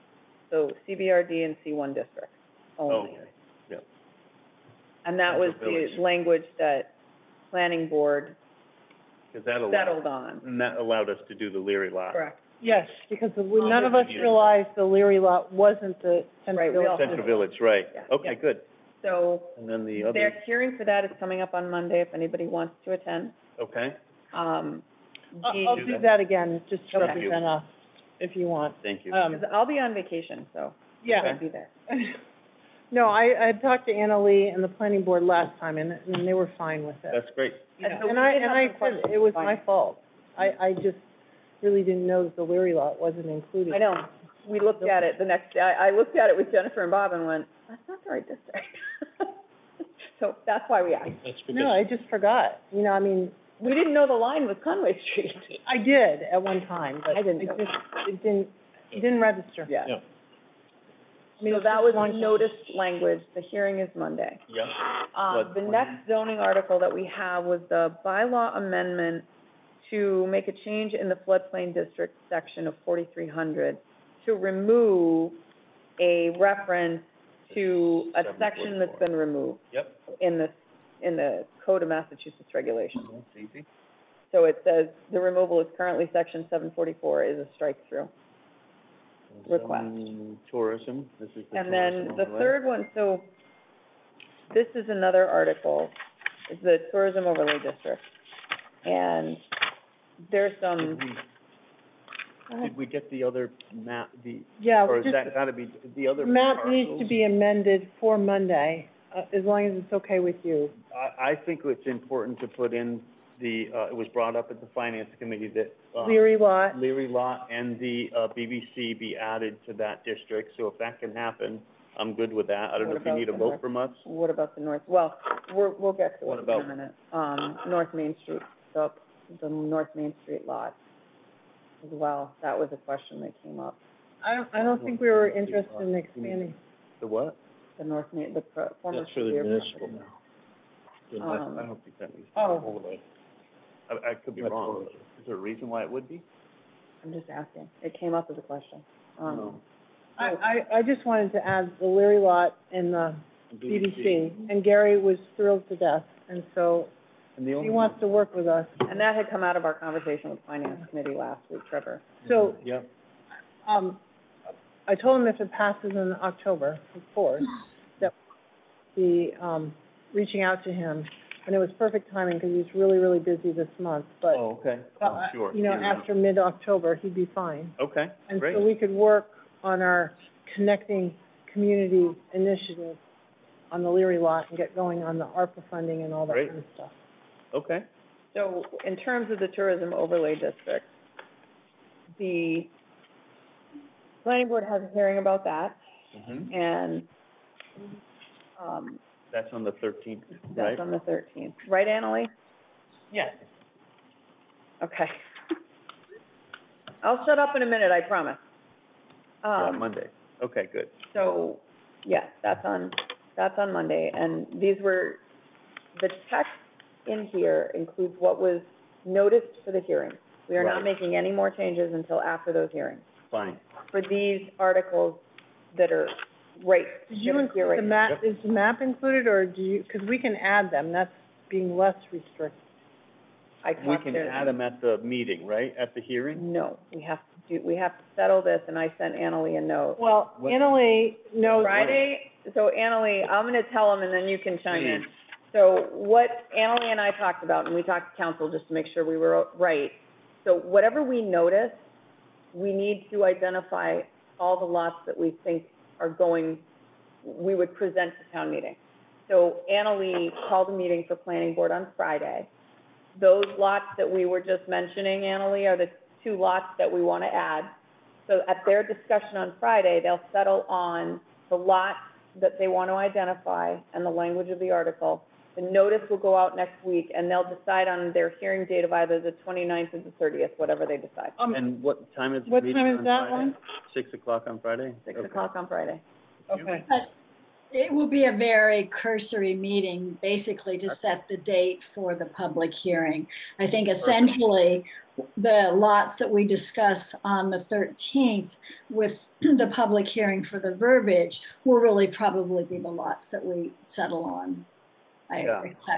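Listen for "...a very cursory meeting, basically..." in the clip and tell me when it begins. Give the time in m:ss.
4:48.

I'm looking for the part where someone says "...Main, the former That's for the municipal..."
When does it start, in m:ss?
2:18.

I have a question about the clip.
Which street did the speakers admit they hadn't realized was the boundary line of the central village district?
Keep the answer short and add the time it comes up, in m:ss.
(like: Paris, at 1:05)
Conway Street, at 0:54.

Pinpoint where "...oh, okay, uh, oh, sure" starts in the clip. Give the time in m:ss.
2:54.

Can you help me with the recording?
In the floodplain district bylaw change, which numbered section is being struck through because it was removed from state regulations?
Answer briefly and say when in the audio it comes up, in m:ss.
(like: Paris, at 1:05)
744, at 1:26.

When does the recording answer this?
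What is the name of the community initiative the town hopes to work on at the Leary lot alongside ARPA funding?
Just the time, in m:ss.
3:00.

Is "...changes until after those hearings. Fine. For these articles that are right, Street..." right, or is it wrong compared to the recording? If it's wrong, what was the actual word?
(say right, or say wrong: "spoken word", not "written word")
wrong: "Did", not "Street".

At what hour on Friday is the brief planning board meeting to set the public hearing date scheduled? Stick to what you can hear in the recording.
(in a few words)
6 o'clock.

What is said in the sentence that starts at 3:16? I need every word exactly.
and, um, That's on the thirteenth, right?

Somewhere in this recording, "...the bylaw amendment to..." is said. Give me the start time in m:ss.
1:07.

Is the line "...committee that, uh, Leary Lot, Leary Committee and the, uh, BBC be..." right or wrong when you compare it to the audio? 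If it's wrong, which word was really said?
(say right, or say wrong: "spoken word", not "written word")
wrong: "Lot", not "Committee".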